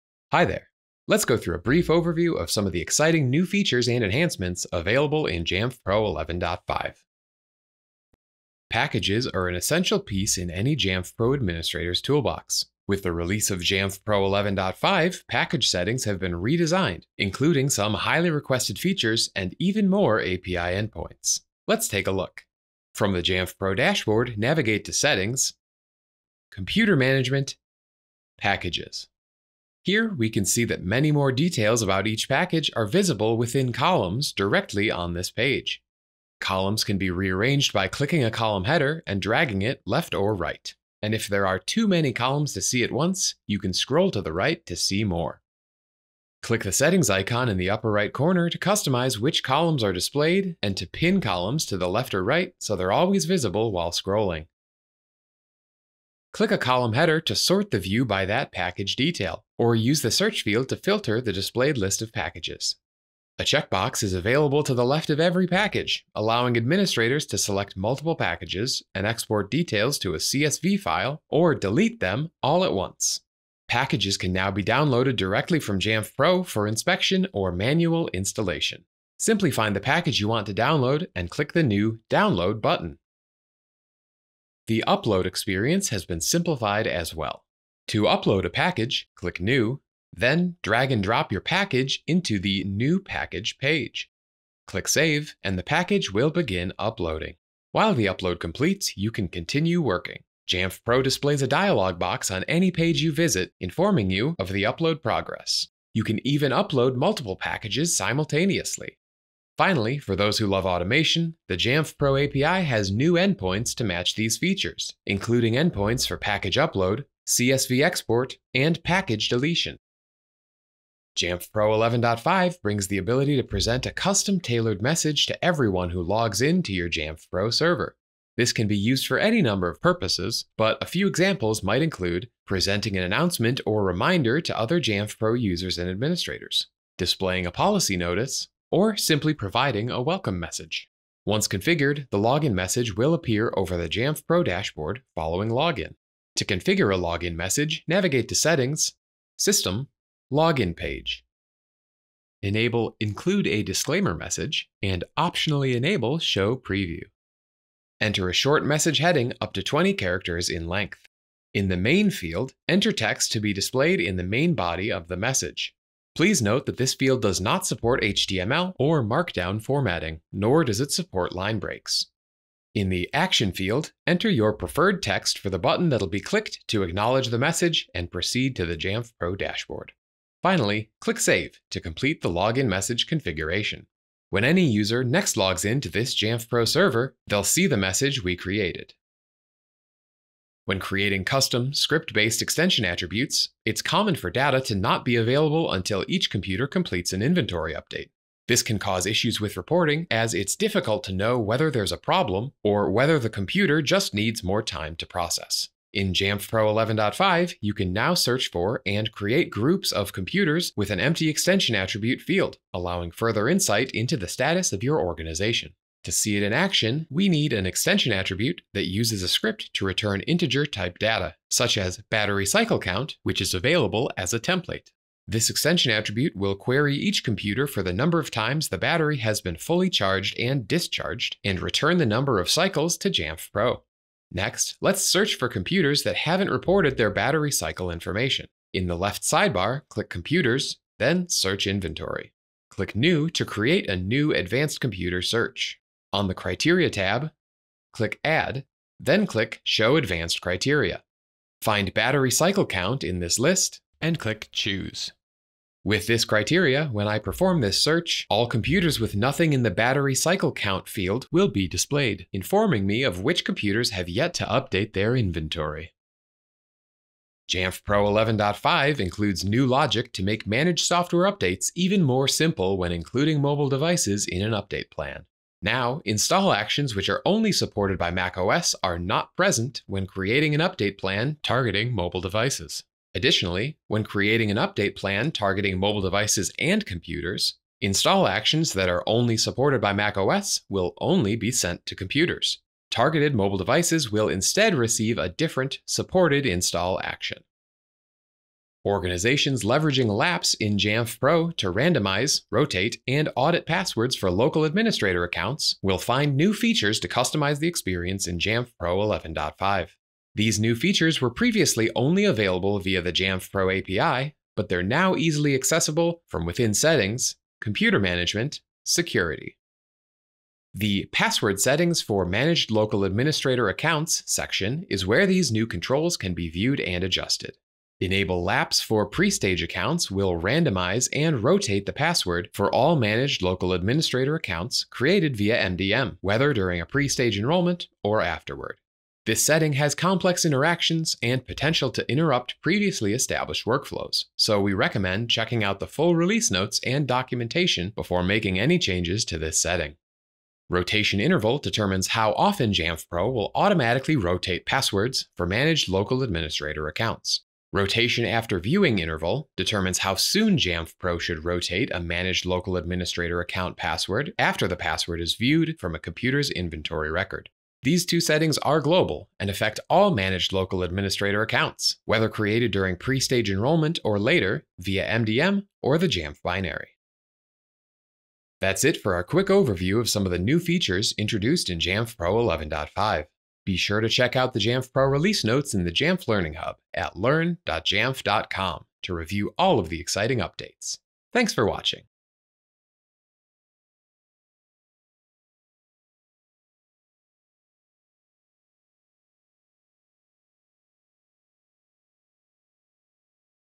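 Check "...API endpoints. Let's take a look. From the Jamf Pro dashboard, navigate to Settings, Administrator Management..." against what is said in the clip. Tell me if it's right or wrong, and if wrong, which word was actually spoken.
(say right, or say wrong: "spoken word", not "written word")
wrong: "Computer", not "Administrator".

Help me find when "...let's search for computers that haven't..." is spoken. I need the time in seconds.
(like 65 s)
234 s.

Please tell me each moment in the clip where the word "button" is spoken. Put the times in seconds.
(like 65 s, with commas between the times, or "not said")
82 s, 175 s.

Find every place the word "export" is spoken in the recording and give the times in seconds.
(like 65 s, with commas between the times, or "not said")
69 s, 117 s.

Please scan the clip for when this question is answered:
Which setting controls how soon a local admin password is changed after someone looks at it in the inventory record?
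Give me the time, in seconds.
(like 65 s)
357 s.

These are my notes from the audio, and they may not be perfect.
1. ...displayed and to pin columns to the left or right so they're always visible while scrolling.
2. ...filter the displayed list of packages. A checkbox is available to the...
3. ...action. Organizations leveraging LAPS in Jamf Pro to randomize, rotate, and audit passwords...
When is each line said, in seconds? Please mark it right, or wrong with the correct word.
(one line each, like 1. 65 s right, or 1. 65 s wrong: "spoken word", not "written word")
1. 49 s right
2. 60 s right
3. 297 s right.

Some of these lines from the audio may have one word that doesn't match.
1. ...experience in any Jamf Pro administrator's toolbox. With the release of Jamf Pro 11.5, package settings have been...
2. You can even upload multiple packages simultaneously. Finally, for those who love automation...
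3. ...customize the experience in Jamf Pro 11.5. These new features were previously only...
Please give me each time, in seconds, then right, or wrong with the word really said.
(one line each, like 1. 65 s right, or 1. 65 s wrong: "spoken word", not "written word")
1. 9 s wrong: "piece", not "experience"
2. 105 s right
3. 307 s right.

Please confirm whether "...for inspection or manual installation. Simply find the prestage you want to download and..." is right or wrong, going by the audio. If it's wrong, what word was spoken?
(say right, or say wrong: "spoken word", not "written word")
wrong: "package", not "prestage".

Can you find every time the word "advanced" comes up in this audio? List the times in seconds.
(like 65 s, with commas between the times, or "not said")
244 s, 249 s.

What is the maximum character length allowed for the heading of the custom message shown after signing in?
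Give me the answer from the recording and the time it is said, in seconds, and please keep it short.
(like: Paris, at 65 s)
20, at 159 s.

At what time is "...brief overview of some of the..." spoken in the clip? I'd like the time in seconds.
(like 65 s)
1 s.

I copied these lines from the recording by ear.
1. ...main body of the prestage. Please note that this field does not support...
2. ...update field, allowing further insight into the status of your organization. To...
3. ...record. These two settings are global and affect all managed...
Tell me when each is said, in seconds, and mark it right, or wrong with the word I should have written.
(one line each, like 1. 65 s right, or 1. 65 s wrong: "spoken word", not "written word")
1. 164 s wrong: "message", not "prestage"
2. 211 s wrong: "attribute", not "update"
3. 367 s right.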